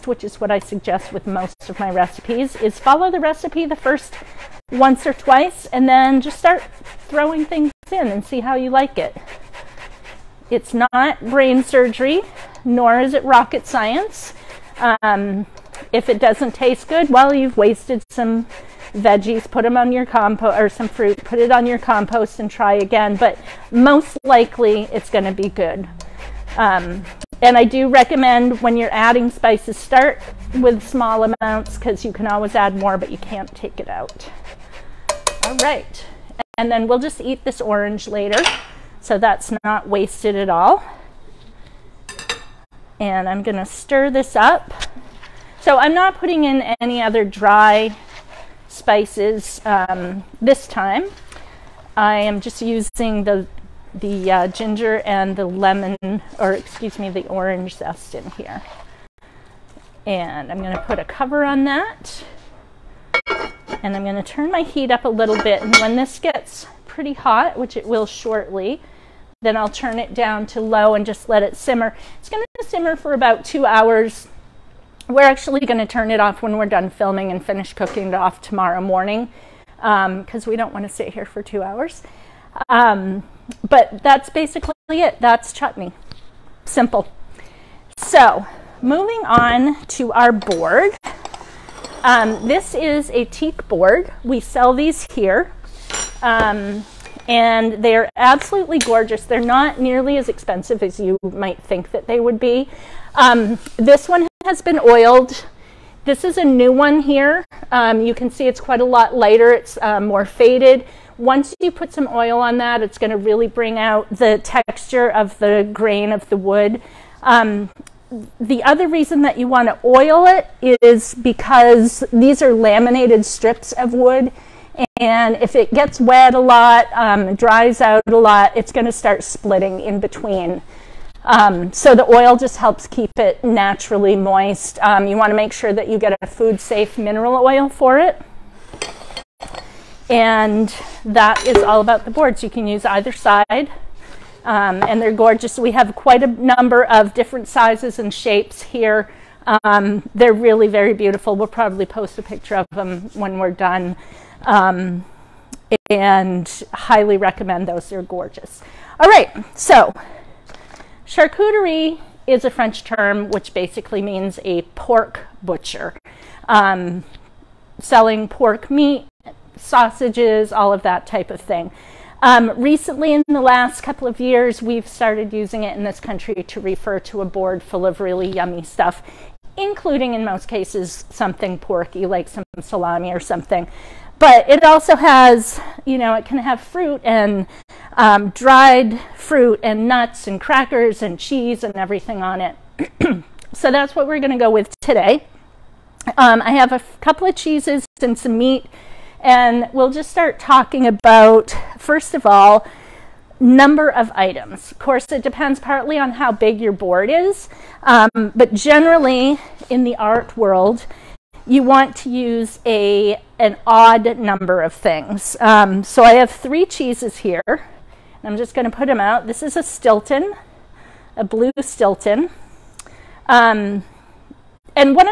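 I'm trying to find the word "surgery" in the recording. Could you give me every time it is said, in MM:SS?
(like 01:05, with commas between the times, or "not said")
00:11.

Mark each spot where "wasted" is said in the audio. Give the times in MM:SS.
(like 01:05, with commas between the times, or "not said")
00:17, 00:39.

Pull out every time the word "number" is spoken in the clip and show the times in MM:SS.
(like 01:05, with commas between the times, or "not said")
02:26, 03:23, 03:34.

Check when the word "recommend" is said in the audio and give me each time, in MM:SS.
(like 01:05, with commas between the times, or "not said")
00:27, 02:37.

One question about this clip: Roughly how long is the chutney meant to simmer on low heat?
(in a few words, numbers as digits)
About two hours.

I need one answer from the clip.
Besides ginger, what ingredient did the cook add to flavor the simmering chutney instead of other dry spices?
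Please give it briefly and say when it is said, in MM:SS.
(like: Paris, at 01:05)
Orange zest, at 00:57.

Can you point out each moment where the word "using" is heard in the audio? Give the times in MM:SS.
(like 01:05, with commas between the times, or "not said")
00:52, 02:55.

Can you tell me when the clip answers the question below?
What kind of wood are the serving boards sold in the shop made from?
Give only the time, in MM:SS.
01:33.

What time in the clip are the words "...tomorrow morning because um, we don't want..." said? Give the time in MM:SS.
01:18.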